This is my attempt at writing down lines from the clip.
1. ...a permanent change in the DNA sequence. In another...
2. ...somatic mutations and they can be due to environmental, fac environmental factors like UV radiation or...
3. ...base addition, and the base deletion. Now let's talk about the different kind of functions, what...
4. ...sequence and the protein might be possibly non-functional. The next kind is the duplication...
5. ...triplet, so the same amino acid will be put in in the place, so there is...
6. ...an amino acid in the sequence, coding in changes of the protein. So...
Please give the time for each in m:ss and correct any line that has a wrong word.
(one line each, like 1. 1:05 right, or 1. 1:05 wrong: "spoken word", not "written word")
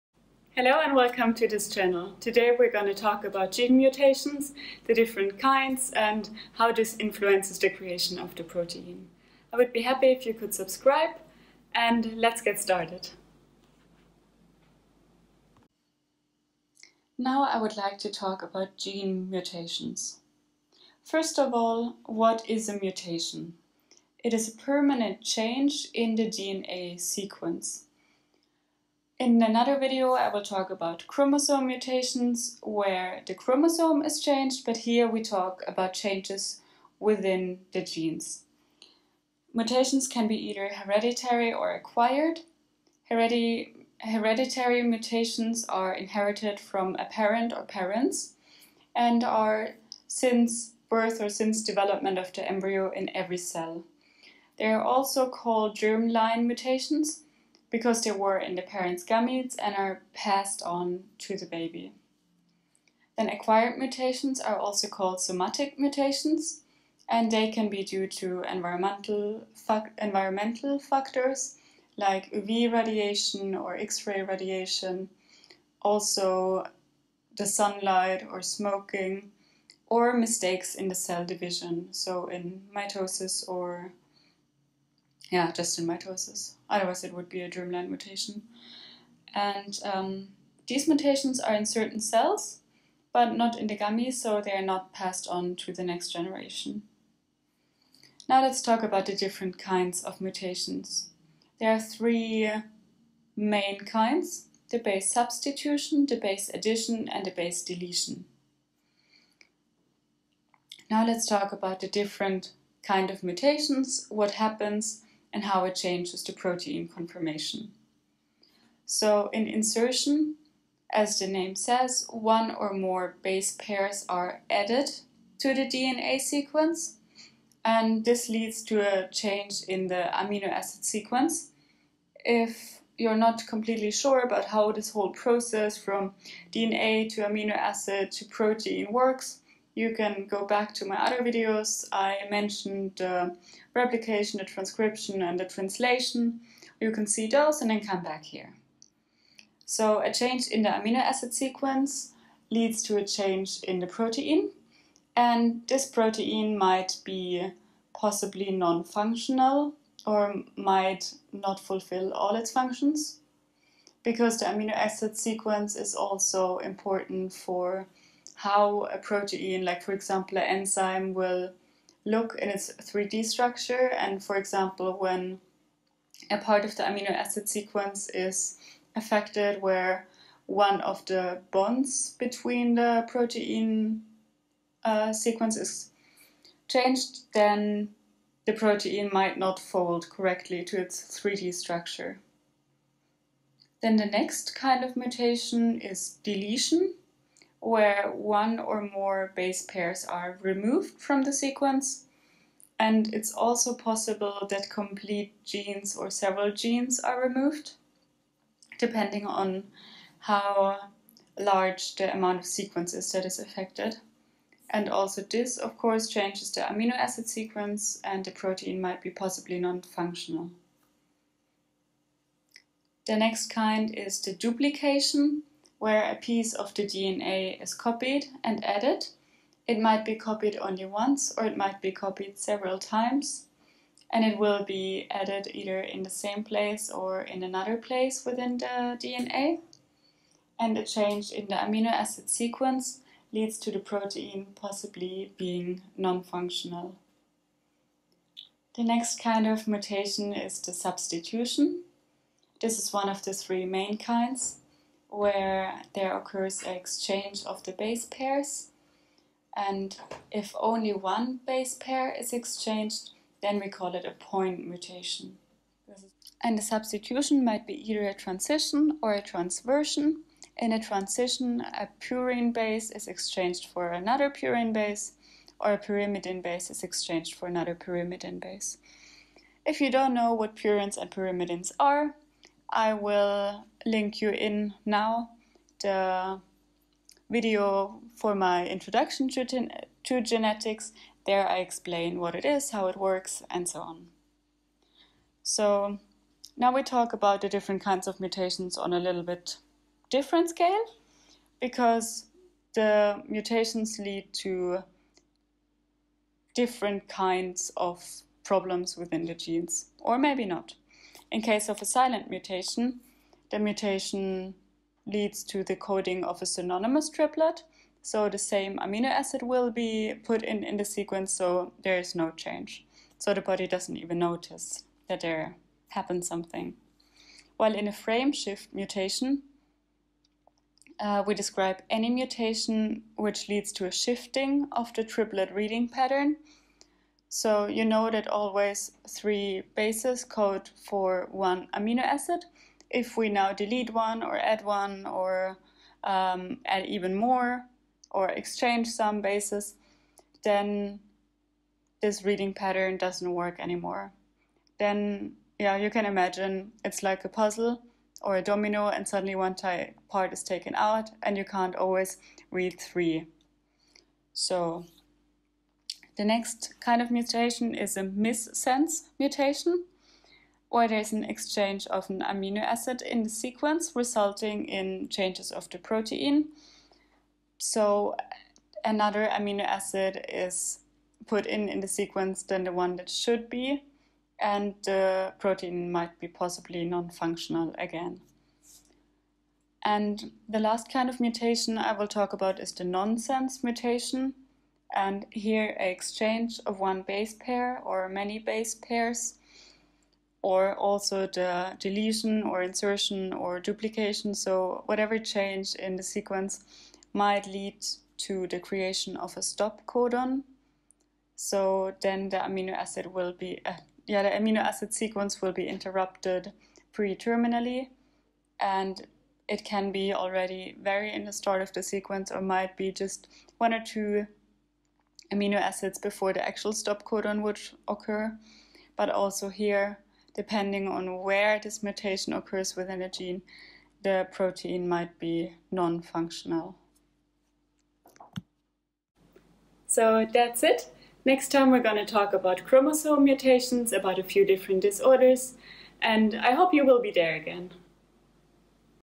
1. 0:24 right
2. 1:05 right
3. 1:46 wrong: "mutations", not "functions"
4. 3:37 right
5. 5:17 wrong: "sequence", not "place"
6. 6:12 wrong: "resulting", not "coding".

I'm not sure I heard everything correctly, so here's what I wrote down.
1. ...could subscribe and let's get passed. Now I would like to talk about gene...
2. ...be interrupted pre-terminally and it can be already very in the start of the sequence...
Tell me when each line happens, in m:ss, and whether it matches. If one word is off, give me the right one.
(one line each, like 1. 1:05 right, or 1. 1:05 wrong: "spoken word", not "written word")
1. 0:10 wrong: "started", not "passed"
2. 6:55 right.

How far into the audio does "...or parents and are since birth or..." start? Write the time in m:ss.
0:47.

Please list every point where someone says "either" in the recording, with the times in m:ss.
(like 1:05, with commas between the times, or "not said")
0:40, 3:55, 4:27.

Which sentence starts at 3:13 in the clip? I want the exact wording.
Then the next kind of mutation is deletion where one or more base pairs are removed from the sequence.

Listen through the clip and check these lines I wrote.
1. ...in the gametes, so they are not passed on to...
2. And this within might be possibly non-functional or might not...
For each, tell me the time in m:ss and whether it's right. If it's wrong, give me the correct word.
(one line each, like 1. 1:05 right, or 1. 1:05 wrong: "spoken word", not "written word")
1. 1:33 right
2. 2:35 wrong: "protein", not "within".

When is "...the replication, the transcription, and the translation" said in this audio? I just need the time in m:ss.
2:22.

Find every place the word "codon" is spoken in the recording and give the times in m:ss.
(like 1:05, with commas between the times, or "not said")
6:49, 7:07.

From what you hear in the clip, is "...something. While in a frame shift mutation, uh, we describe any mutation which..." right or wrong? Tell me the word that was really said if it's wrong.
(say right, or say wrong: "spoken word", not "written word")
right.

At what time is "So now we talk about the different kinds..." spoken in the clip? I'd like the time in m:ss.
4:55.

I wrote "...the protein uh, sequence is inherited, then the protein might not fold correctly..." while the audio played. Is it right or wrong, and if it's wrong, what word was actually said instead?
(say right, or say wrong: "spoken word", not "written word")
wrong: "changed", not "inherited".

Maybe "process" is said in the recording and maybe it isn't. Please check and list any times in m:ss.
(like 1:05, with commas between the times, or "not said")
2:15.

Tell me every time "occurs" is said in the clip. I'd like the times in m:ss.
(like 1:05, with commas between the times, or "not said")
4:16, 7:07, 7:12.